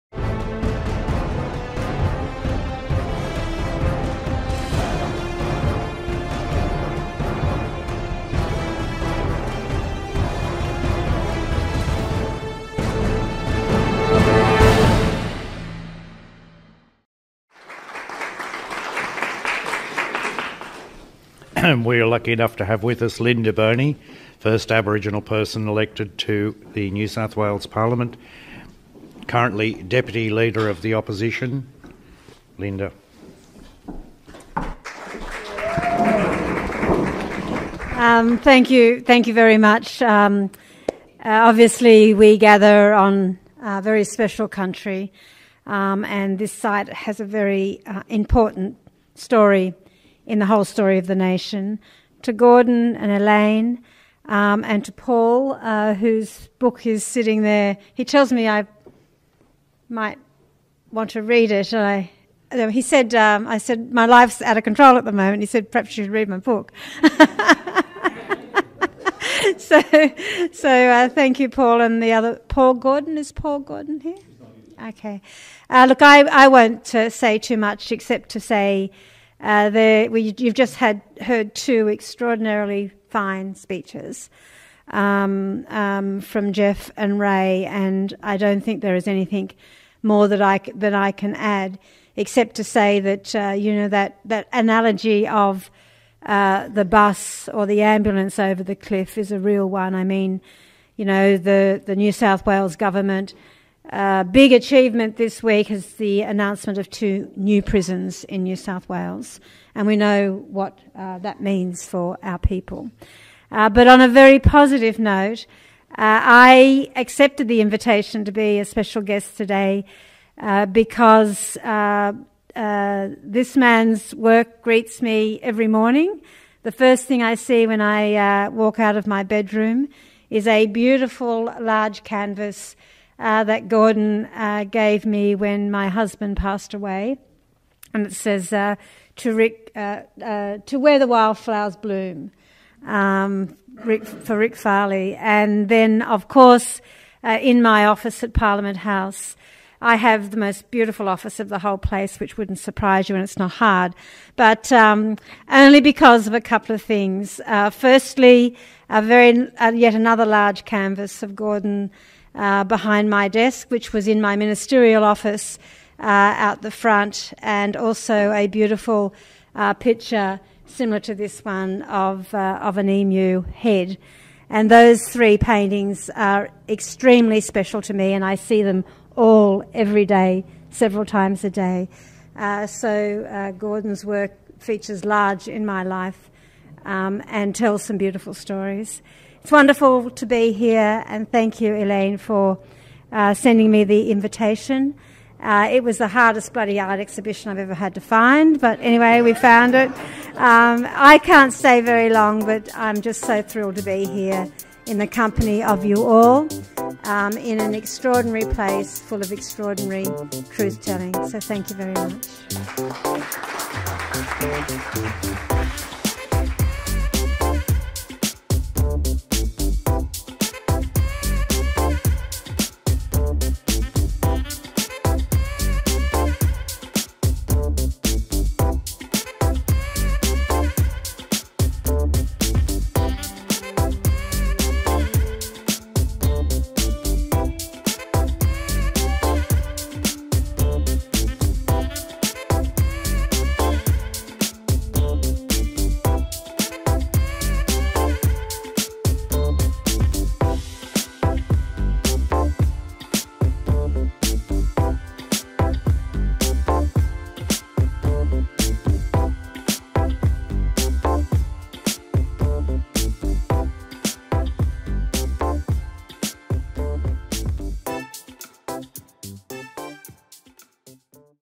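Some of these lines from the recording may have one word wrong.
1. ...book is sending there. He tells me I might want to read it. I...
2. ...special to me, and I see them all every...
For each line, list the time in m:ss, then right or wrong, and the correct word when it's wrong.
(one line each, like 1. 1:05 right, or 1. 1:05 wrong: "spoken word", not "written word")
1. 0:56 wrong: "sitting", not "sending"
2. 2:57 right.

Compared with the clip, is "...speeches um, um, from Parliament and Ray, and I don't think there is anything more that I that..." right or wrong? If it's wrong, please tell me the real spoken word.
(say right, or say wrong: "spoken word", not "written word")
wrong: "Jeff", not "Parliament".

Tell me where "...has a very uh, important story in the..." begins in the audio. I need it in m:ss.
0:46.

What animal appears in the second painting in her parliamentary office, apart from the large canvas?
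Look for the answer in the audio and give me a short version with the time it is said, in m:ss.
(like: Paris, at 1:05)
Emu, at 2:52.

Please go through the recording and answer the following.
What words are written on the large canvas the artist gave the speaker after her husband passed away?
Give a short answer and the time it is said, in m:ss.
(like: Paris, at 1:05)
To where the wildflowers bloom, at 2:20.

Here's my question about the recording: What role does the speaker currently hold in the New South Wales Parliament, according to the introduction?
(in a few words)
Deputy Leader of the Opposition.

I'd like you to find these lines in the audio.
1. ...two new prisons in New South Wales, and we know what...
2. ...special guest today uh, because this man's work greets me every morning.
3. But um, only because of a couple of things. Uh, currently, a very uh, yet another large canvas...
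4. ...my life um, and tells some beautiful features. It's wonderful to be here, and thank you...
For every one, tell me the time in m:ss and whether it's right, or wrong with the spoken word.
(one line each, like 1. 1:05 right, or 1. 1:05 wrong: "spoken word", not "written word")
1. 1:46 right
2. 1:58 right
3. 2:34 wrong: "firstly", not "currently"
4. 3:05 wrong: "stories", not "features".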